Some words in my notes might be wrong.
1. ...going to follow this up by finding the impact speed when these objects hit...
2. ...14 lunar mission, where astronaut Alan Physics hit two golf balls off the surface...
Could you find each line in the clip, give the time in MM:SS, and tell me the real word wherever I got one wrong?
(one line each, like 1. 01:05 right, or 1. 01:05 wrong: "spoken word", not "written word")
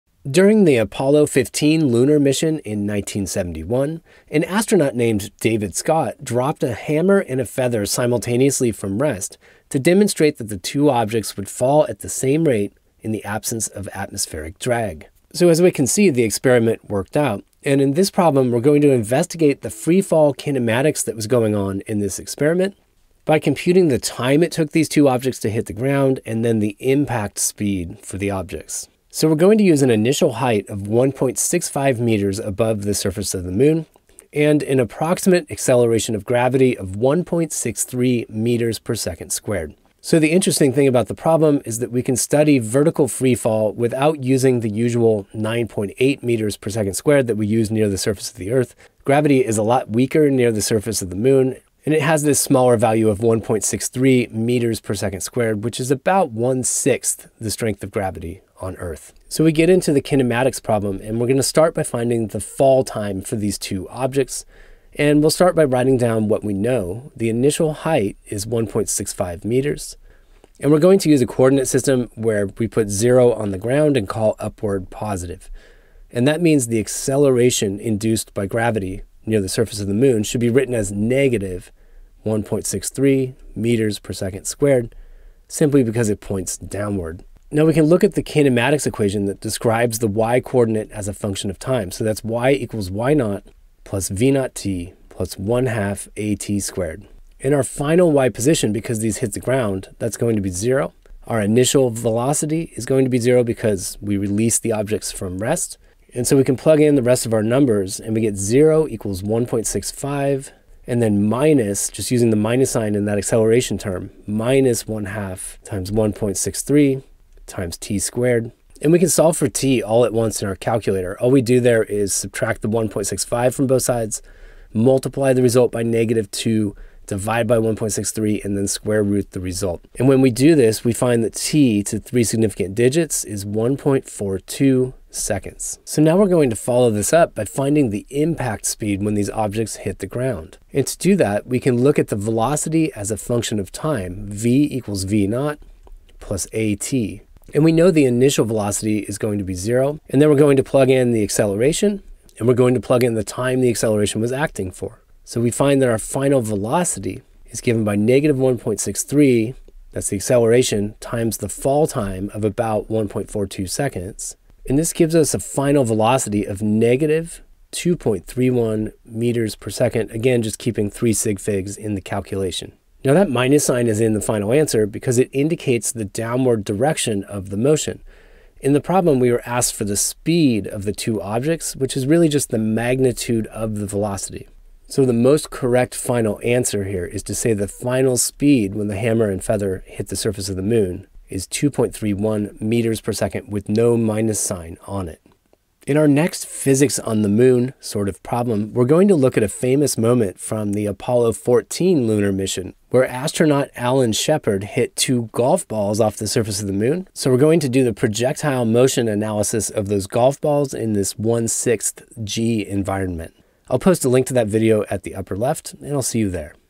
1. 02:16 right
2. 03:21 wrong: "Shepard", not "Physics".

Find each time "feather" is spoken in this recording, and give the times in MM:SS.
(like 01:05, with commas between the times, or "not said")
00:07, 03:09.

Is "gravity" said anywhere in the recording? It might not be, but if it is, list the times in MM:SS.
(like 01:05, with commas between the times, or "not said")
00:36, 00:49, 00:57, 01:18.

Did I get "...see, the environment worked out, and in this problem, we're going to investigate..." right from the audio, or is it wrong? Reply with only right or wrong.
wrong.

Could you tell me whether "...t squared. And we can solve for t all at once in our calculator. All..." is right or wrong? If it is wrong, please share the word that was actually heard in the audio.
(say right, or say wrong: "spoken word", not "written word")
right.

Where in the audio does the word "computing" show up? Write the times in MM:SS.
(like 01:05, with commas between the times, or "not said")
00:23.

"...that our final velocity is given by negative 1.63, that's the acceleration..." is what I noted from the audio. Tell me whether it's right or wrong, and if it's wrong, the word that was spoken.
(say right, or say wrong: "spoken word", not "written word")
right.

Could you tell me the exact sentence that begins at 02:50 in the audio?
Again, just keeping three sig figs in the calculation.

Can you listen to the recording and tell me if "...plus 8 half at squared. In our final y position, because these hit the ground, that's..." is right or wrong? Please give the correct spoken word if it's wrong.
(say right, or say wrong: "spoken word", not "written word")
wrong: "1", not "8".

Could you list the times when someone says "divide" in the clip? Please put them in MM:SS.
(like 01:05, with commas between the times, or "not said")
02:07.